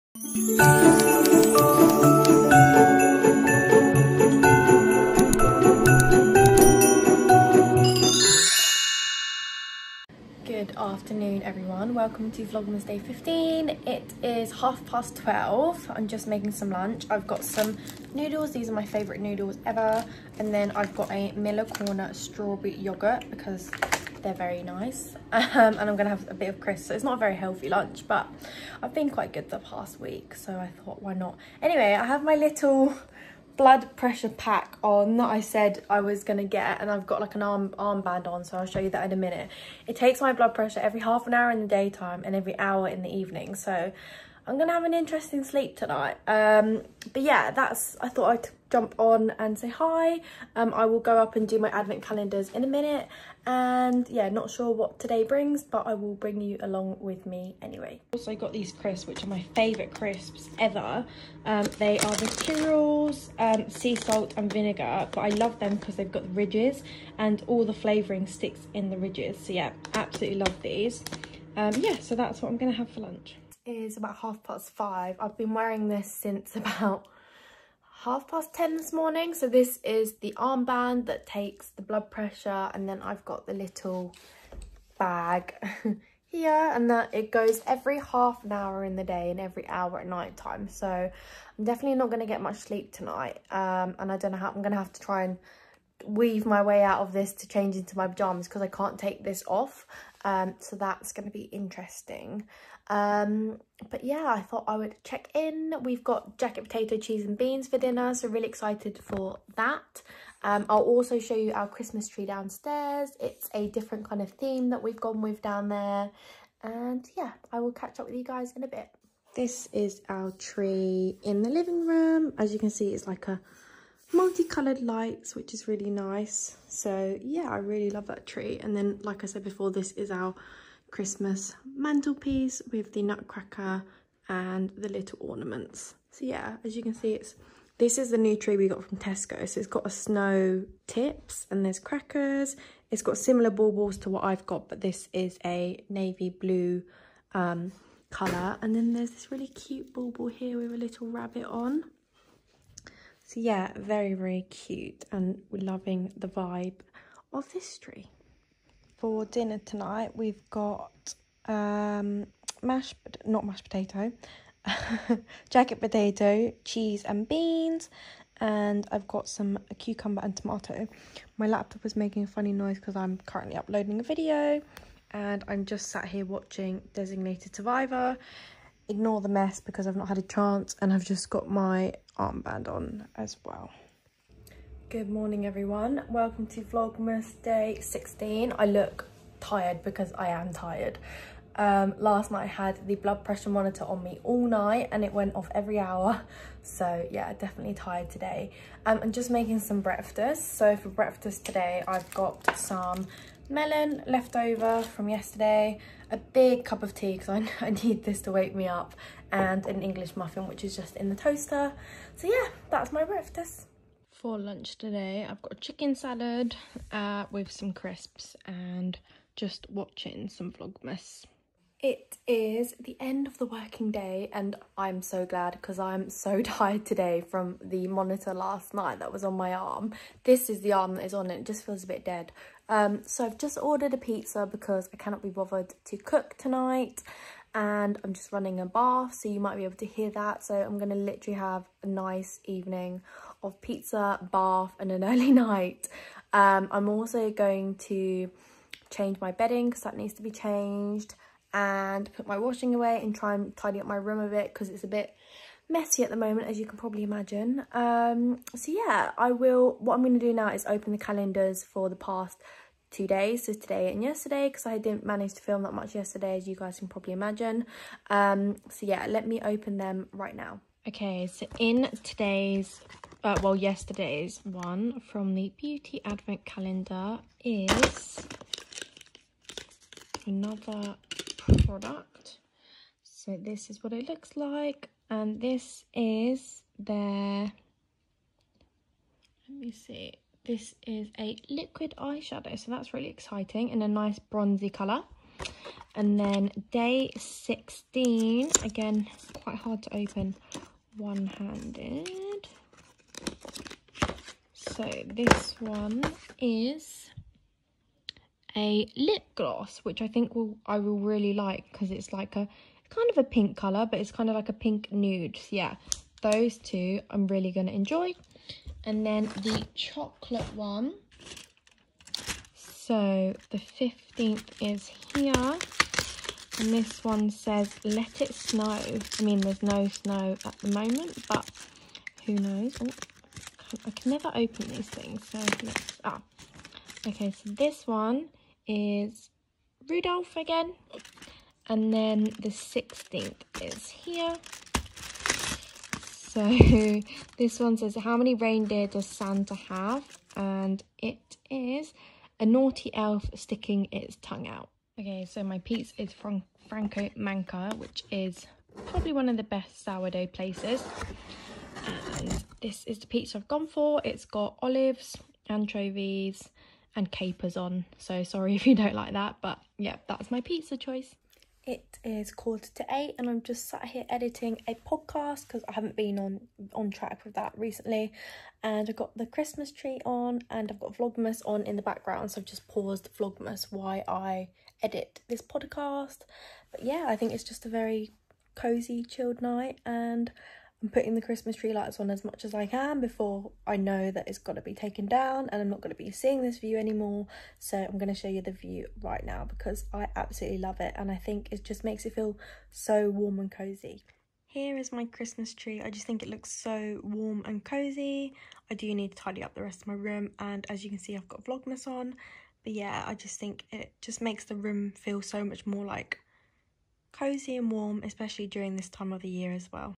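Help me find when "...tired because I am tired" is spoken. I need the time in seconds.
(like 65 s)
189 s.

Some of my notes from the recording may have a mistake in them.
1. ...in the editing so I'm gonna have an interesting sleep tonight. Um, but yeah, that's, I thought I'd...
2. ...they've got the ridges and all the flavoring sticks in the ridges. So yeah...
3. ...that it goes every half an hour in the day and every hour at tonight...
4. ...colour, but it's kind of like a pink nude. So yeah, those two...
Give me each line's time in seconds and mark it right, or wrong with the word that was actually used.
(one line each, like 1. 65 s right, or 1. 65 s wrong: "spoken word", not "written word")
1. 42 s wrong: "evening", not "editing"
2. 65 s right
3. 86 s wrong: "night", not "tonight"
4. 313 s right.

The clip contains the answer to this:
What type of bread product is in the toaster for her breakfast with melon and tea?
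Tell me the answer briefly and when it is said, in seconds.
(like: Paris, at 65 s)
English muffin, at 209 s.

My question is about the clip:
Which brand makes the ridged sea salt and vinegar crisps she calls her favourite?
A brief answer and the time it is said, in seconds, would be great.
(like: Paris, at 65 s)
Tyrrell's, at 62 s.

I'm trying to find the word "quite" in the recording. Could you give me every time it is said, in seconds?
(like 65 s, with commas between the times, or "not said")
29 s, 299 s.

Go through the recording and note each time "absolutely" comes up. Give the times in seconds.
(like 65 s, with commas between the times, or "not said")
69 s, 400 s.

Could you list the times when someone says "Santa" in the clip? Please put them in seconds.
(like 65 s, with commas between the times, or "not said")
349 s.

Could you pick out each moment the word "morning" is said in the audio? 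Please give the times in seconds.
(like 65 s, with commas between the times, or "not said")
78 s, 185 s.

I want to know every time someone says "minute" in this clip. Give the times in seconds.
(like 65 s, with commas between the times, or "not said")
39 s, 52 s.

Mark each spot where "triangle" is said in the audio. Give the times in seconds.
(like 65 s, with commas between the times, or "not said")
not said.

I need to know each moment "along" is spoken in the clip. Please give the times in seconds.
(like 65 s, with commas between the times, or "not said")
56 s.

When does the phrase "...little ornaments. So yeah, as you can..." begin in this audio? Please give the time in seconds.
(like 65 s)
134 s.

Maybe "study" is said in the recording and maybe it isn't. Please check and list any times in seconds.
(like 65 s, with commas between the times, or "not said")
not said.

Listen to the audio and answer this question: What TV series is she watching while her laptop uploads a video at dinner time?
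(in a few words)
Designated Survivor.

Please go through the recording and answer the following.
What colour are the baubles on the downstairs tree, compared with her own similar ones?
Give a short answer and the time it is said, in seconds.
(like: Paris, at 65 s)
Navy blue, at 145 s.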